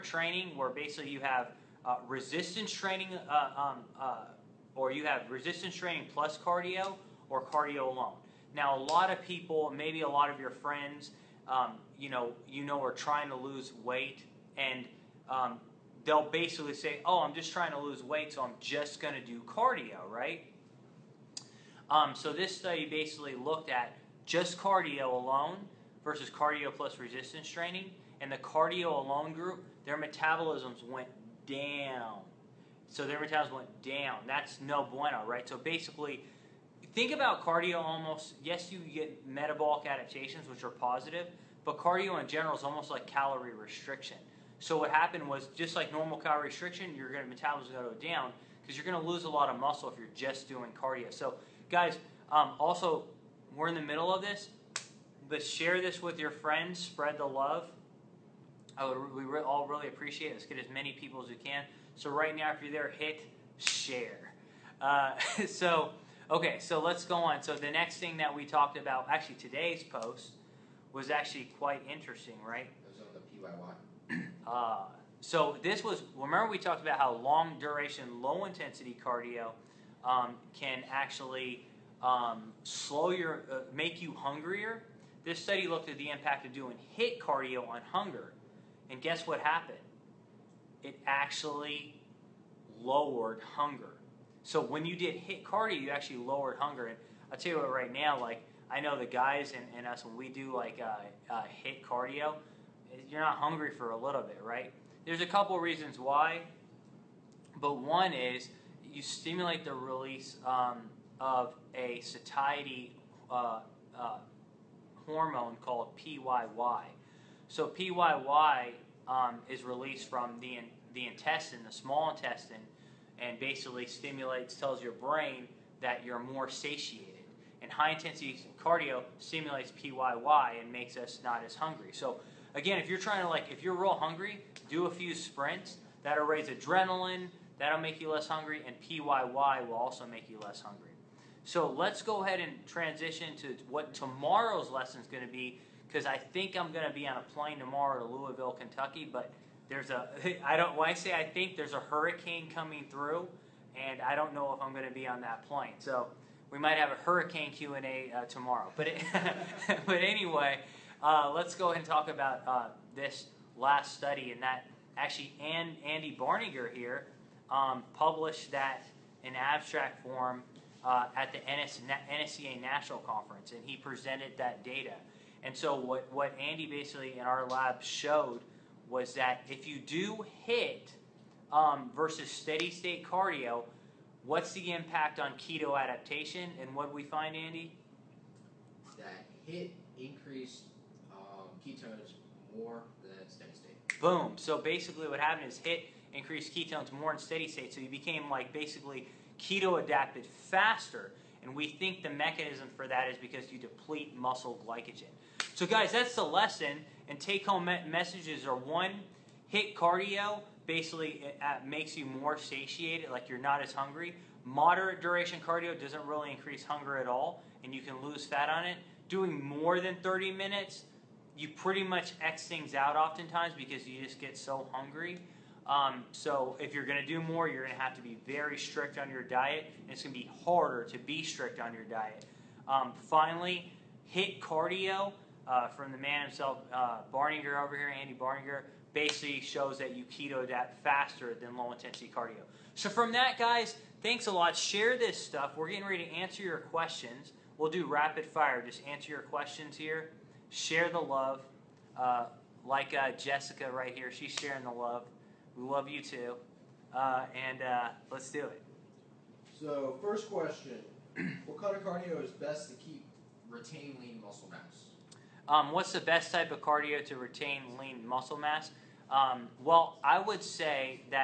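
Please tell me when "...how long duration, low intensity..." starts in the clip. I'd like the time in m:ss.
1:16.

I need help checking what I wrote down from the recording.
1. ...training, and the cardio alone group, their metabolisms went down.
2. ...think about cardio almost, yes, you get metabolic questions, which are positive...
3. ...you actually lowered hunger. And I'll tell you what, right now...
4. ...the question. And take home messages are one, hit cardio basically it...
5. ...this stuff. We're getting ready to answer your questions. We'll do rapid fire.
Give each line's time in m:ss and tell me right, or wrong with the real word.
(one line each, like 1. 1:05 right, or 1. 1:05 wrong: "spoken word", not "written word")
1. 0:27 right
2. 0:36 wrong: "adaptations", not "questions"
3. 1:35 right
4. 3:26 wrong: "lesson", not "question"
5. 4:04 right.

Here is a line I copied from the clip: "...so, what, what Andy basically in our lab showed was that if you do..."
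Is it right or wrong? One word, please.
right.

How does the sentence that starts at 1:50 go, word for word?
Um, of a satiety uh, uh, hormone called PYY.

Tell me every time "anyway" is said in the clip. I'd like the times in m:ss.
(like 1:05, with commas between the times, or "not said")
2:39.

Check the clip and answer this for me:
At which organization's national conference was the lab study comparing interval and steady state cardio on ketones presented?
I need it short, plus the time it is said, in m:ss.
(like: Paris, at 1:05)
NSCA, at 2:52.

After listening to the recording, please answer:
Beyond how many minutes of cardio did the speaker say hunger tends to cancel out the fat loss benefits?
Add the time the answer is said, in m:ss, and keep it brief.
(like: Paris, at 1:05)
30 minutes, at 3:40.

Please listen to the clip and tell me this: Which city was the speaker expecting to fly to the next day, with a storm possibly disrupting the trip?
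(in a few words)
Louisville, Kentucky.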